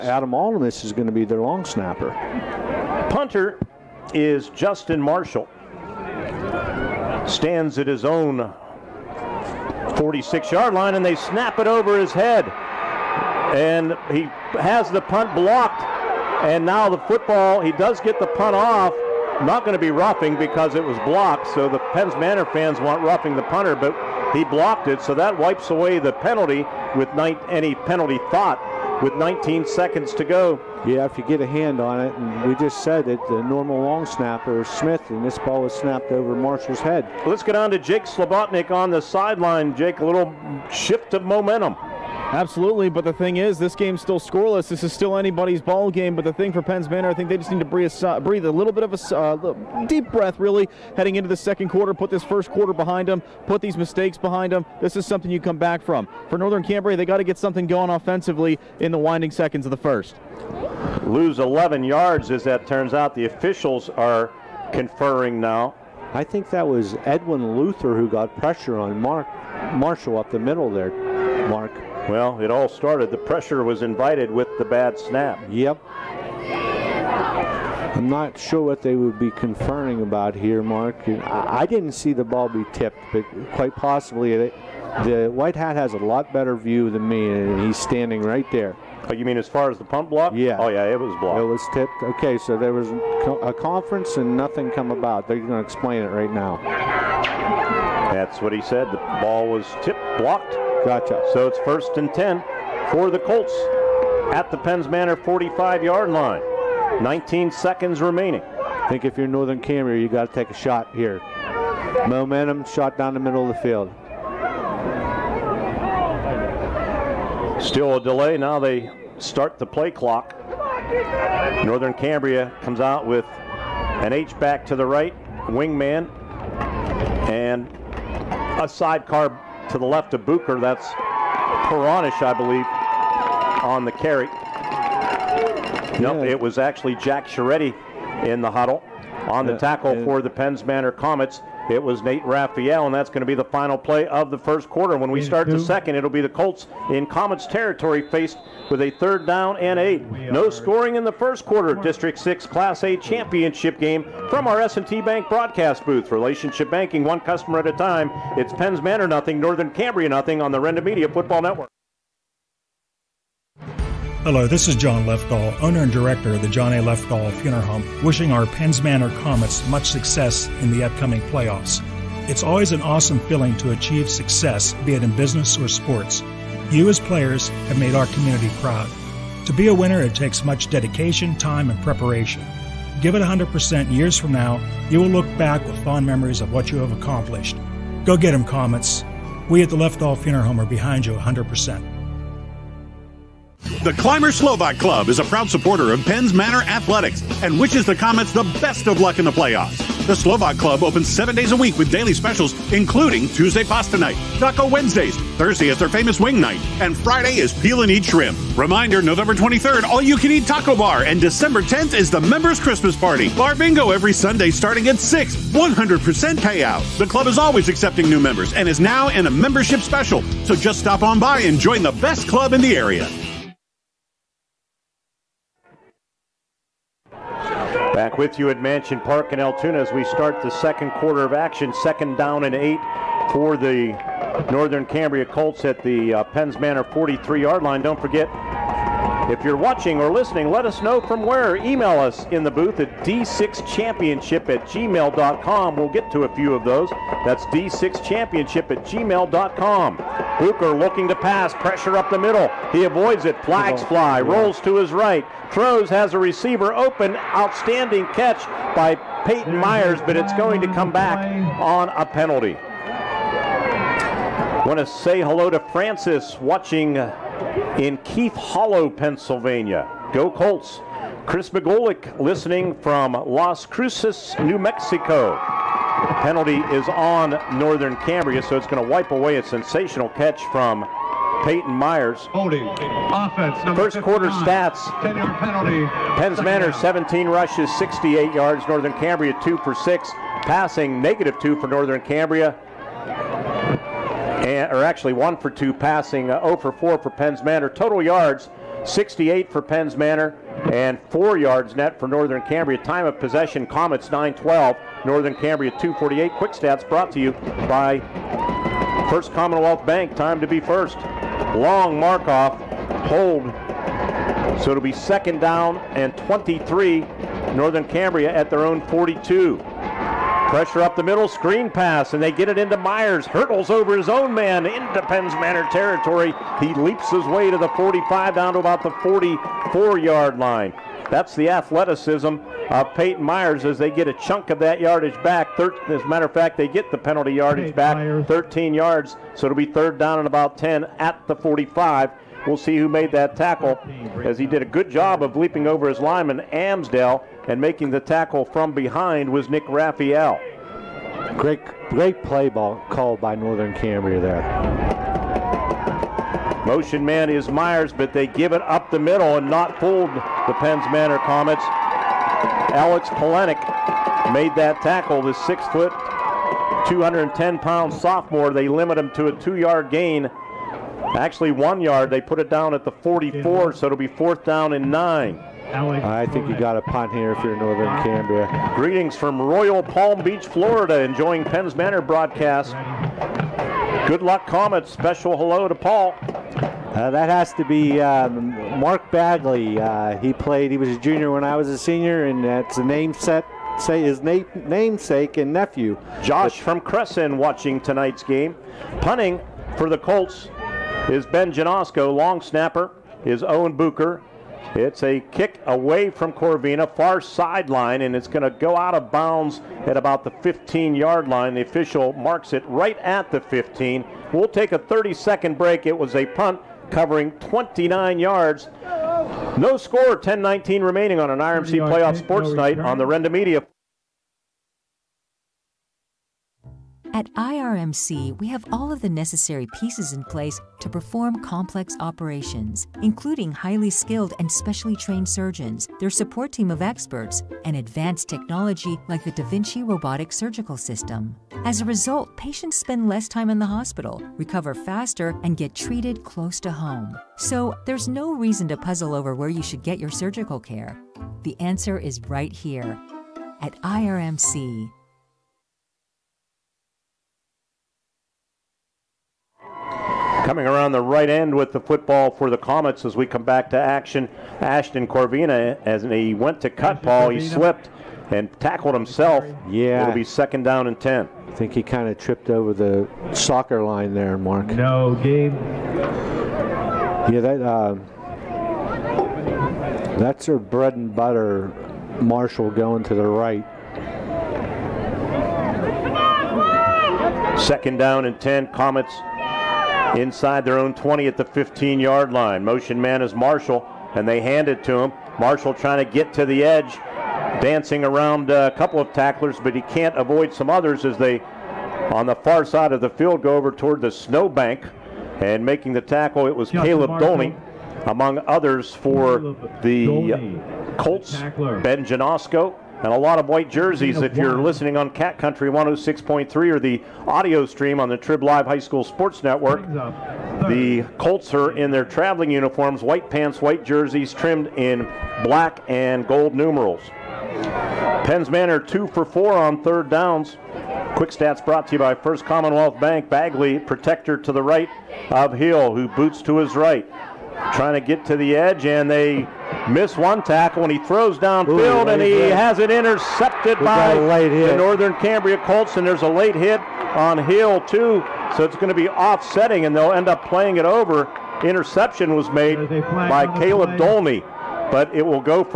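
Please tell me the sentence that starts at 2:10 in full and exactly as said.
That's Peronish, I believe, on the carry.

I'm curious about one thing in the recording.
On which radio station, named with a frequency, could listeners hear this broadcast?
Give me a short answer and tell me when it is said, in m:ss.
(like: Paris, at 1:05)
Cat Country 106.3, at 8:35.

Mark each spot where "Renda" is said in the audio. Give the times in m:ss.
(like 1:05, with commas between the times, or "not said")
2:40, 7:03.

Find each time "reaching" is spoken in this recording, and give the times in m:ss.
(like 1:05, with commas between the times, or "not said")
not said.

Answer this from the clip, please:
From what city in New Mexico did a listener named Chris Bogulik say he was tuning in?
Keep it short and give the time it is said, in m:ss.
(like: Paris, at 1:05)
Las Cruces, at 4:33.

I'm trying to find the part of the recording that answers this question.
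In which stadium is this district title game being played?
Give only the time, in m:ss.
3:48.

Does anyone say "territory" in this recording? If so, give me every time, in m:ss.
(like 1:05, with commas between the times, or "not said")
2:27, 5:25.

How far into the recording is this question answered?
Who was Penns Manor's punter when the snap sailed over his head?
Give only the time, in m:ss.
0:04.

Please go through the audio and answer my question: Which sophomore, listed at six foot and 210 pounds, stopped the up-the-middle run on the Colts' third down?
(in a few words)
Alex Polenik.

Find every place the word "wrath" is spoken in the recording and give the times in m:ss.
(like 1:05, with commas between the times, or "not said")
not said.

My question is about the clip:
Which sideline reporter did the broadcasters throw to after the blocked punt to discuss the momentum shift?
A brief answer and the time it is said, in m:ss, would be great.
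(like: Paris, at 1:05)
Jake Slobotnik, at 0:37.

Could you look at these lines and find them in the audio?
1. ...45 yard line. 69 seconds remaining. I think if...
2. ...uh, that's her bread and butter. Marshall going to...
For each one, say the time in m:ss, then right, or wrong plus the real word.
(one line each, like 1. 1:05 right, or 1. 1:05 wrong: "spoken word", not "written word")
1. 1:45 wrong: "19", not "69"
2. 7:57 right.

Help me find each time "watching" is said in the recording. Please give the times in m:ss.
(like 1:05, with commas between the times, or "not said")
3:59, 4:26, 6:37.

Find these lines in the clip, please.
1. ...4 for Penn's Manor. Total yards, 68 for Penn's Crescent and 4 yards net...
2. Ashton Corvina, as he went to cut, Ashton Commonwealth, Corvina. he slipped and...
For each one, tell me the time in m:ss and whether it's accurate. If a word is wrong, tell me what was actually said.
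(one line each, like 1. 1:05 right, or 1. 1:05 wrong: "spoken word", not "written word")
1. 4:56 wrong: "Manor", not "Crescent"
2. 7:44 wrong: "Paul", not "Commonwealth".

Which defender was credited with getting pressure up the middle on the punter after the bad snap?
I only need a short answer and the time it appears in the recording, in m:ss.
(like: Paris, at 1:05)
Edwin Luther, at 1:07.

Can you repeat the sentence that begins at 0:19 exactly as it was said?
Not going to be roughing because it was blocked.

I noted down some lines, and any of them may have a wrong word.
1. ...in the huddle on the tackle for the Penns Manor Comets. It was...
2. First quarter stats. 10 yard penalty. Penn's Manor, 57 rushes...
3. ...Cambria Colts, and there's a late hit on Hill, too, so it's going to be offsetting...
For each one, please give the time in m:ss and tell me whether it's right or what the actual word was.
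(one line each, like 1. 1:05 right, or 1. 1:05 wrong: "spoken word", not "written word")
1. 2:18 right
2. 4:43 wrong: "17", not "57"
3. 9:05 right.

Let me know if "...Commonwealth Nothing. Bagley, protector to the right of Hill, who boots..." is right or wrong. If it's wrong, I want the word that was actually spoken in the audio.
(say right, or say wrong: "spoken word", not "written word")
wrong: "Bank", not "Nothing".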